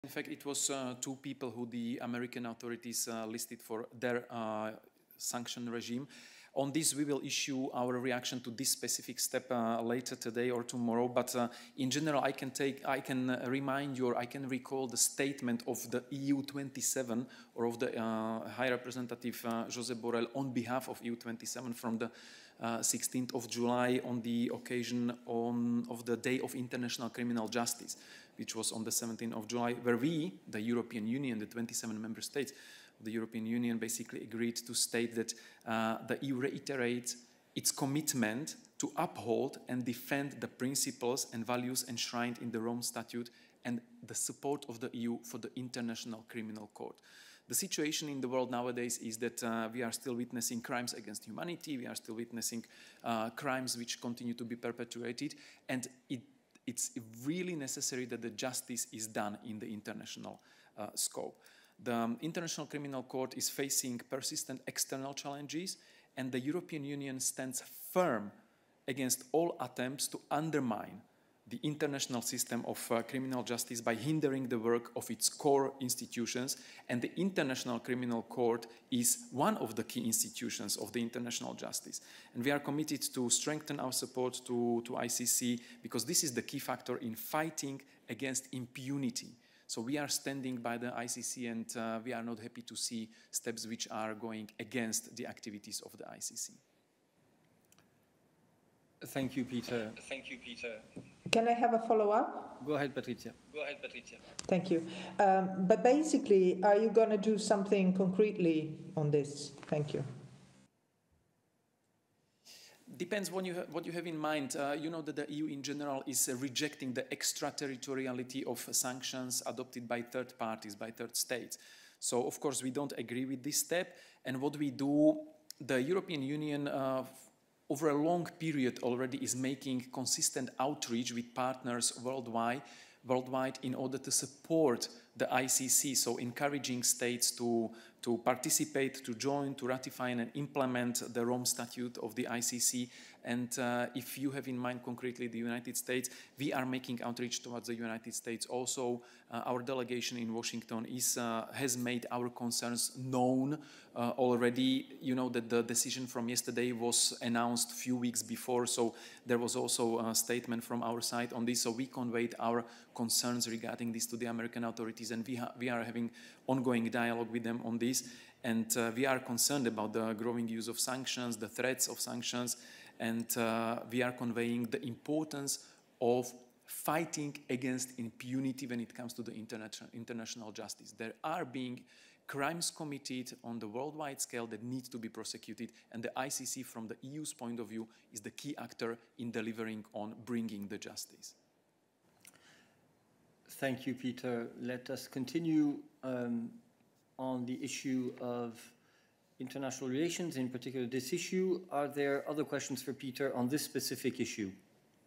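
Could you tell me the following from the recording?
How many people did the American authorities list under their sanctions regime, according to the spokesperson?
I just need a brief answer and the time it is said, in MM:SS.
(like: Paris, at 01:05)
2, at 00:00.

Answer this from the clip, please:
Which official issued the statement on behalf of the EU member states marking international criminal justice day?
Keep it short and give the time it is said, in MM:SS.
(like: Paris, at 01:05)
Josep Borrell, at 00:19.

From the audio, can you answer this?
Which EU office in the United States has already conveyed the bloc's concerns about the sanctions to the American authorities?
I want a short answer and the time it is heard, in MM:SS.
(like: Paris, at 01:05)
delegation in Washington, at 02:29.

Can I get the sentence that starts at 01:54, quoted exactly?
Uh, you know that the EU in general is uh, rejecting the extraterritoriality of sanctions adopted by third parties, by third states.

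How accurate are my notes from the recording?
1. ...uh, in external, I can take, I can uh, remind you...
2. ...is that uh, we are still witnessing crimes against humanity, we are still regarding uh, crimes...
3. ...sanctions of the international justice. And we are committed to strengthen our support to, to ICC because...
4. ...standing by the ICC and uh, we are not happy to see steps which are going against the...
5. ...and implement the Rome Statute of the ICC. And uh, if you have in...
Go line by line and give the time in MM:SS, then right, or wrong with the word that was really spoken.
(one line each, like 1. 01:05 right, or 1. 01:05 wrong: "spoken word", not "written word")
1. 00:11 wrong: "general", not "external"
2. 00:48 wrong: "witnessing", not "regarding"
3. 01:20 wrong: "institutions", not "sanctions"
4. 01:30 right
5. 02:20 right.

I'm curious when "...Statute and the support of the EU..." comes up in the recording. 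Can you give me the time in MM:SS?
00:42.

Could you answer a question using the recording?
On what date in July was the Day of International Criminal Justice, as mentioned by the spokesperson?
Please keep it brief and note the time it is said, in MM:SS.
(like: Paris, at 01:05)
17th of July, at 00:28.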